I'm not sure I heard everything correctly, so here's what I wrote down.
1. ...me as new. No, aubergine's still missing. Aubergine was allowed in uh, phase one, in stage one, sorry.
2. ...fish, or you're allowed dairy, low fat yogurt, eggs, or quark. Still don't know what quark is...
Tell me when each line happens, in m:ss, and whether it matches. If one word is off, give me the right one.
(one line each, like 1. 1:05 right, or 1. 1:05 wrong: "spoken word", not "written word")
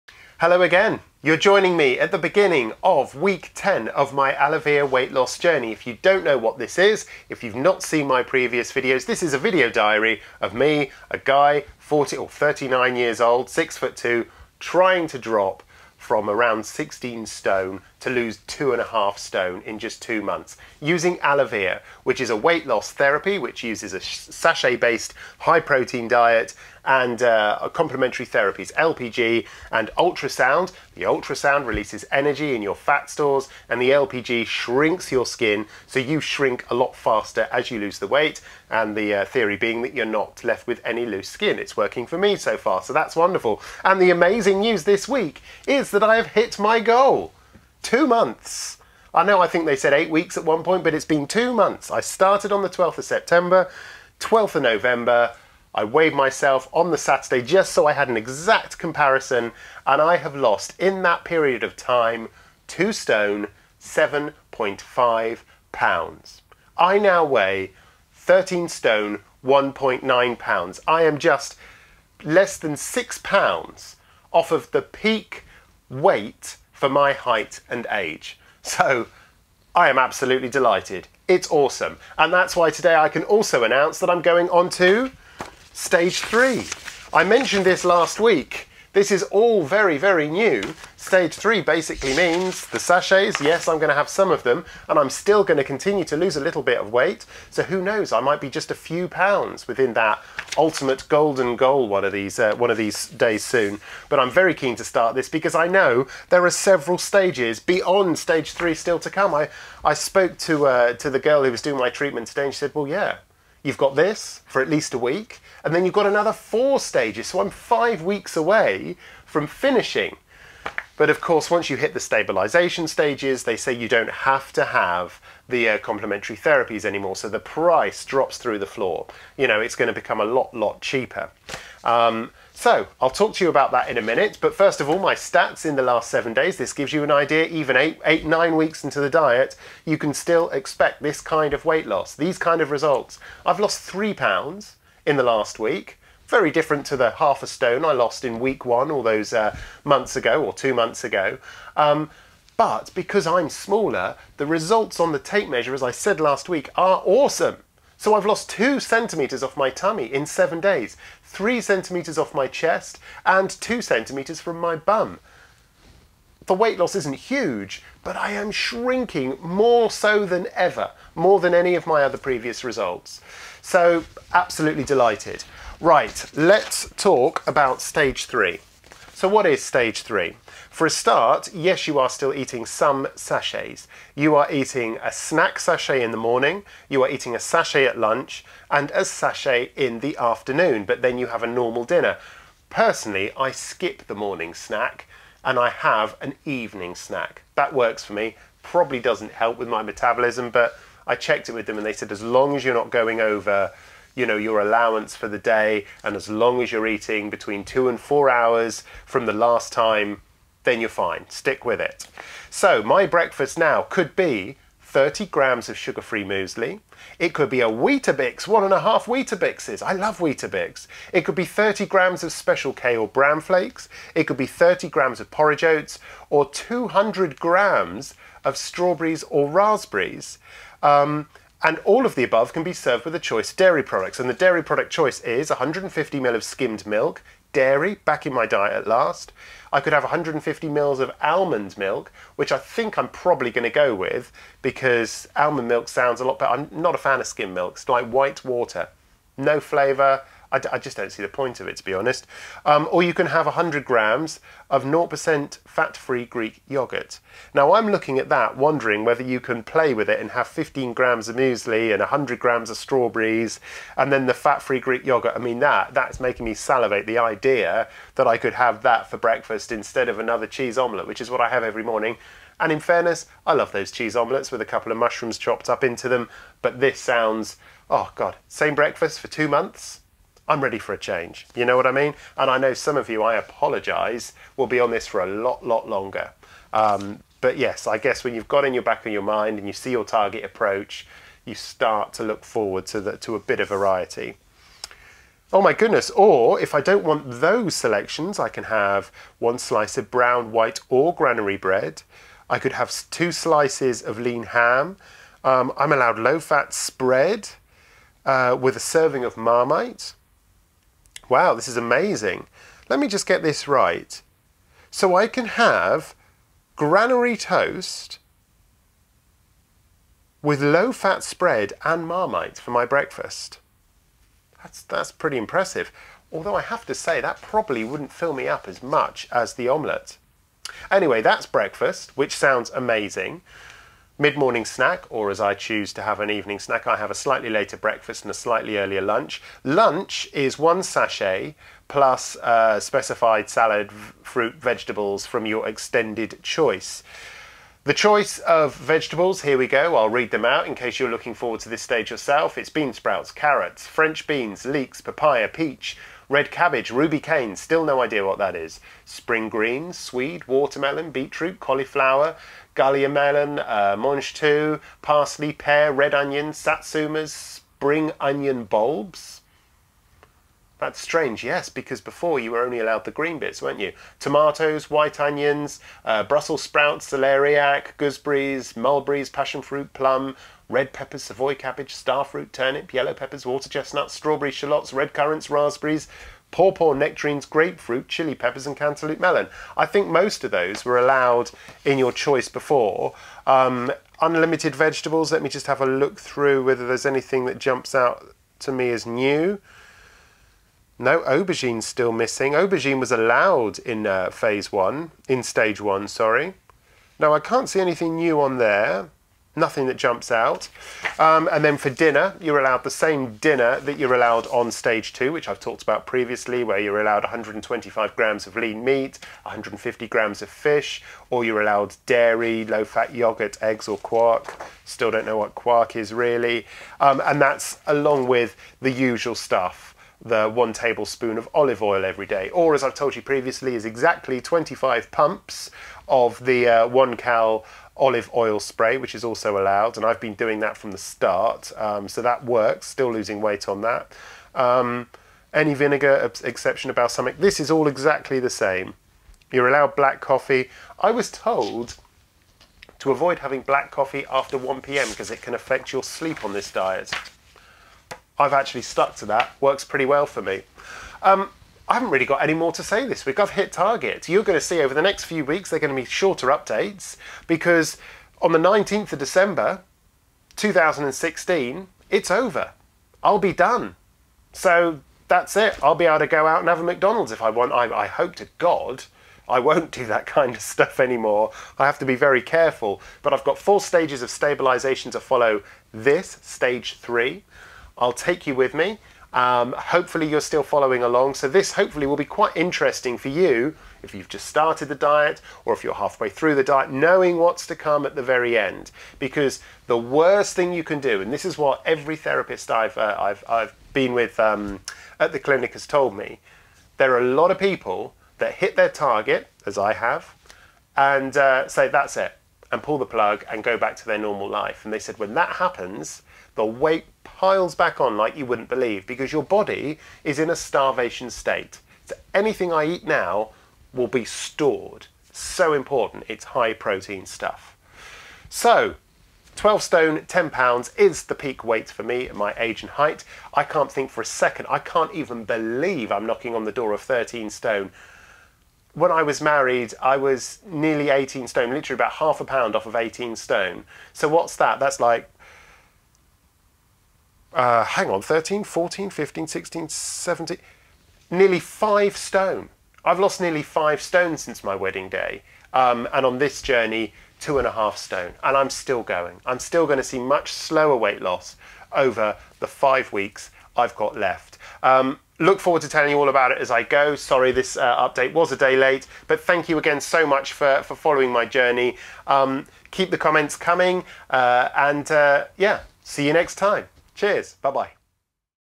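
1. 6:38 right
2. 7:00 right.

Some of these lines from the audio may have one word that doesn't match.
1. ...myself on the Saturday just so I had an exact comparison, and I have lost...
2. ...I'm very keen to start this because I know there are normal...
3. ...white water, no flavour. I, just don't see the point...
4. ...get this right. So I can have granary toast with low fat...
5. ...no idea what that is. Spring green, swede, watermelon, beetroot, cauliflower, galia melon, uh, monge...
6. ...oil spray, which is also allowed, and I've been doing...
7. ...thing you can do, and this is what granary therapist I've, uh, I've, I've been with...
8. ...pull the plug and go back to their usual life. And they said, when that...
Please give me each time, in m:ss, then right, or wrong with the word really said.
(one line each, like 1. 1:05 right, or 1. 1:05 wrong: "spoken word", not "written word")
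1. 0:56 right
2. 1:44 wrong: "several", not "normal"
3. 4:08 right
4. 5:13 right
5. 5:57 right
6. 7:18 right
7. 8:20 wrong: "every", not "granary"
8. 8:32 wrong: "normal", not "usual".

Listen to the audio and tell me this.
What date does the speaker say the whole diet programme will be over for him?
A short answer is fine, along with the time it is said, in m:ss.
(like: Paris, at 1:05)
19 December 2016, at 7:48.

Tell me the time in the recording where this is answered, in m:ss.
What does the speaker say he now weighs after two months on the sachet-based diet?
1:08.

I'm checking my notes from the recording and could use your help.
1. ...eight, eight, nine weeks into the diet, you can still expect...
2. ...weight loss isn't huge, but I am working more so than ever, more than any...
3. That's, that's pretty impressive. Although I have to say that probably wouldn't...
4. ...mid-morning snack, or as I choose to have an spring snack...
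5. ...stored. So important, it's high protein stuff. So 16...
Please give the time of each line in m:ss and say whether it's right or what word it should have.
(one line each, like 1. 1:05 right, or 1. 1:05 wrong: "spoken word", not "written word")
1. 2:17 right
2. 2:46 wrong: "shrinking", not "working"
3. 5:24 right
4. 5:34 wrong: "evening", not "spring"
5. 8:44 wrong: "12", not "16".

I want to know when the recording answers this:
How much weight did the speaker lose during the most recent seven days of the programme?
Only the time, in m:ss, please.
2:23.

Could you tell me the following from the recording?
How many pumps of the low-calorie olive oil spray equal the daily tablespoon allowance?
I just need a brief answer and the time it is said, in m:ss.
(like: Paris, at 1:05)
25, at 7:14.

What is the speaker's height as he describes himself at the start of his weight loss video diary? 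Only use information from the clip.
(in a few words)
6 foot 2.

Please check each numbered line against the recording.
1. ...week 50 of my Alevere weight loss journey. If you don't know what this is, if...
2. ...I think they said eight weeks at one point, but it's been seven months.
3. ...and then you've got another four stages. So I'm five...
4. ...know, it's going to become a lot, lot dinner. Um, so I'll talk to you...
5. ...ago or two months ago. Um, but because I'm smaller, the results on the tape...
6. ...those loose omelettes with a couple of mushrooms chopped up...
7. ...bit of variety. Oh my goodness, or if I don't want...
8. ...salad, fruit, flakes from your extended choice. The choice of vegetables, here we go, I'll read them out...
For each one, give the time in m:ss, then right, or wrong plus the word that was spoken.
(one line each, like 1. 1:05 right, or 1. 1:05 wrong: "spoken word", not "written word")
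1. 0:03 wrong: "10", not "50"
2. 0:49 wrong: "two", not "seven"
3. 1:55 right
4. 2:09 wrong: "cheaper", not "dinner"
5. 2:30 right
6. 4:33 wrong: "cheese", not "loose"
7. 4:53 right
8. 5:43 wrong: "vegetables", not "flakes".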